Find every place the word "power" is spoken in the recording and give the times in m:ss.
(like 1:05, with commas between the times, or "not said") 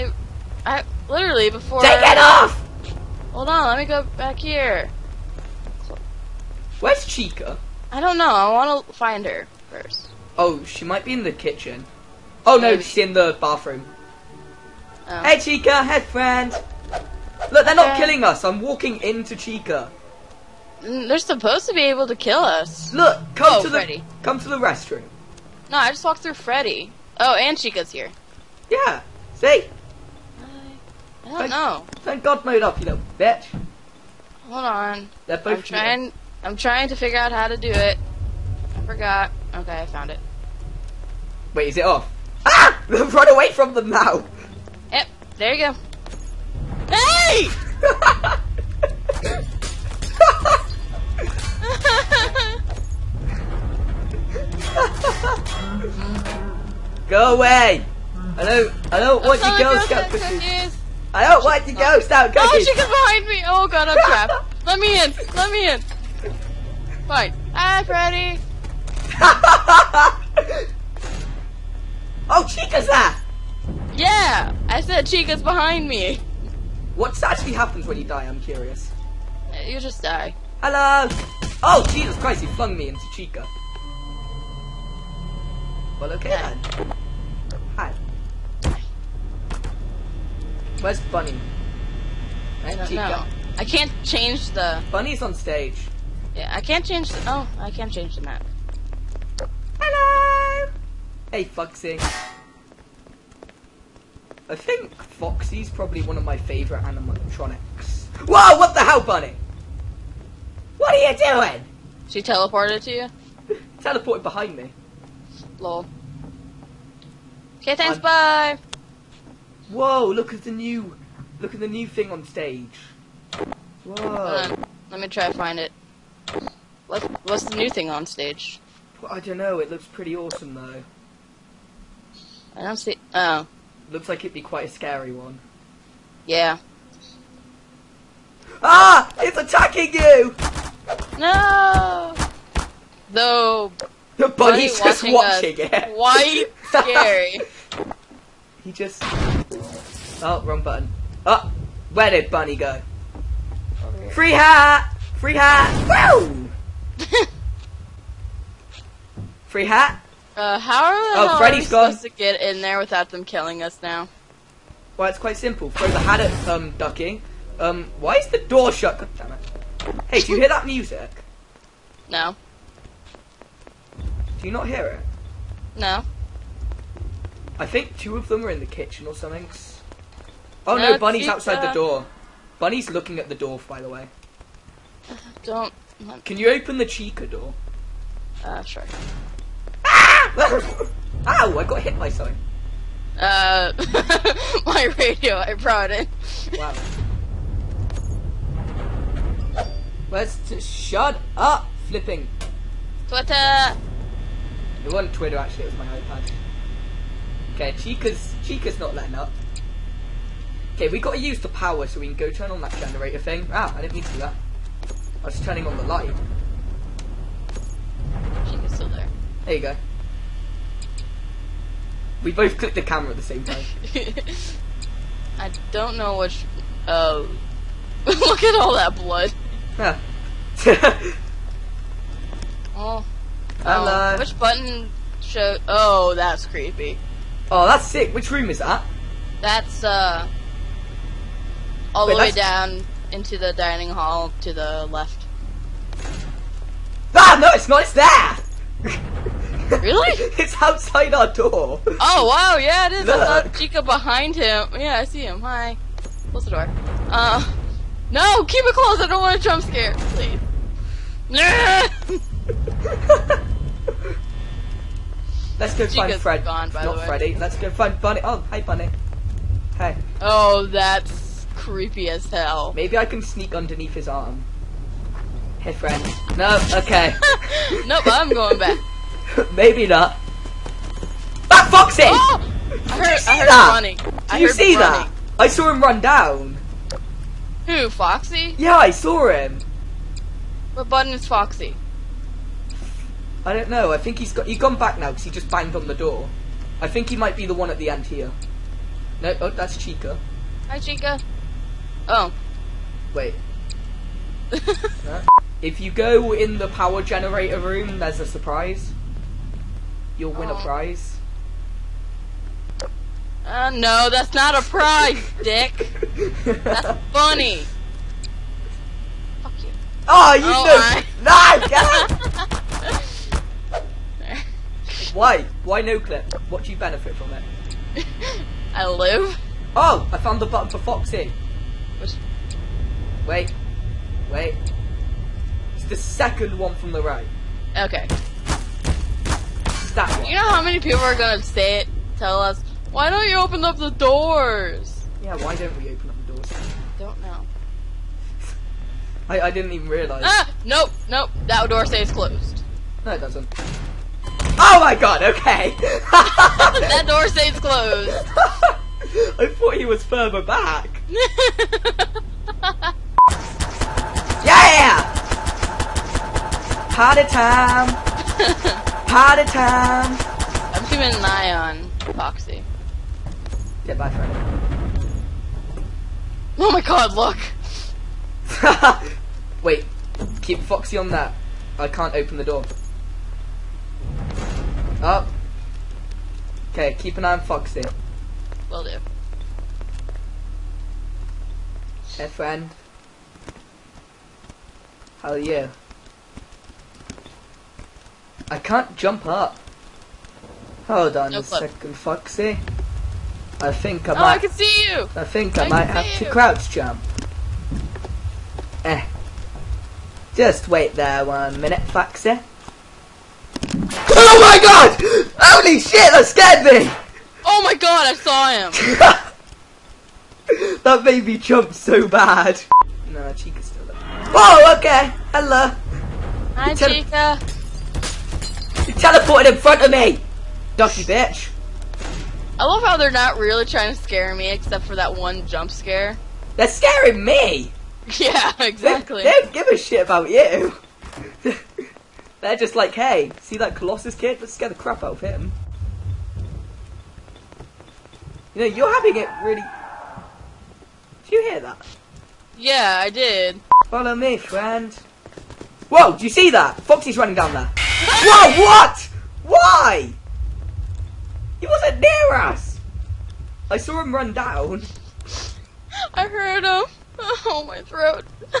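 3:31, 5:06.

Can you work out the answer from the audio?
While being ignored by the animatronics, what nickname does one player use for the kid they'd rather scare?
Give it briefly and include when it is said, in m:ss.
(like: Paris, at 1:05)
Colossus kid, at 7:23.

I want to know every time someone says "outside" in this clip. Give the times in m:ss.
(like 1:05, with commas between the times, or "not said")
3:01, 4:10.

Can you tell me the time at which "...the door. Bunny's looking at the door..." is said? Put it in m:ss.
3:01.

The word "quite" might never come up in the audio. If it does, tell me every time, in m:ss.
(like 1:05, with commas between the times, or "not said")
2:14, 2:45.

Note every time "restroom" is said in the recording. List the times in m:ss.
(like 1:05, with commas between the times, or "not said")
0:24.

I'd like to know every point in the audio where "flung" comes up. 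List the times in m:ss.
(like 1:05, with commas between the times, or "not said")
1:22.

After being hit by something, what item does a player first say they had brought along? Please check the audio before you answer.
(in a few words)
Radio.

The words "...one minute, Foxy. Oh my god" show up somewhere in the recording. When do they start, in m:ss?
6:51.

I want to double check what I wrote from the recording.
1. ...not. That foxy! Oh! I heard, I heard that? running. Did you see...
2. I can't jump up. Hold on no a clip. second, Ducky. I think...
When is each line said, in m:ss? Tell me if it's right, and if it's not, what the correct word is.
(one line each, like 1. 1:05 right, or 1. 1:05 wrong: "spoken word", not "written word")
1. 4:39 right
2. 6:38 wrong: "Foxy", not "Ducky".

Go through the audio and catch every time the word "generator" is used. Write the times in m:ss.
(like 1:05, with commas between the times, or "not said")
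3:32, 5:07.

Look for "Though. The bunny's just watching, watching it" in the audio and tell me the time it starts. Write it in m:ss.
2:23.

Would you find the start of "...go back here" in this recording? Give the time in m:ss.
0:03.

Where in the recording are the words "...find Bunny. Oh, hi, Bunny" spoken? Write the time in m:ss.
4:27.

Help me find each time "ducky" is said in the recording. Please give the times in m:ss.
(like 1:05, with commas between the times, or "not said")
2:46, 7:10.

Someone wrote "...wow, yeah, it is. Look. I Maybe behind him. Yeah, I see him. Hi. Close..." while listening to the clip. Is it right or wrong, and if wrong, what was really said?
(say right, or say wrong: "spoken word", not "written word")
wrong: "Chica", not "Maybe".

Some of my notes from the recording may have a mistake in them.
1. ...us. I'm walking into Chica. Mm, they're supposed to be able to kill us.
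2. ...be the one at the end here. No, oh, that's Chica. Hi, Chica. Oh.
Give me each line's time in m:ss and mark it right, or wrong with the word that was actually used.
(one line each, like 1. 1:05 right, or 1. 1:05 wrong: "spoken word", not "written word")
1. 0:18 right
2. 4:57 right.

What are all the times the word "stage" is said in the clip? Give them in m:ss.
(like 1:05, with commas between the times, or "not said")
1:35, 2:02, 2:08.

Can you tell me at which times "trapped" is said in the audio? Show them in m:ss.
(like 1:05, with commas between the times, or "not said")
1:04.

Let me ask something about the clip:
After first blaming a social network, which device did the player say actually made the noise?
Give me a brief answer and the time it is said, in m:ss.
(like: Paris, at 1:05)
iPad, at 3:26.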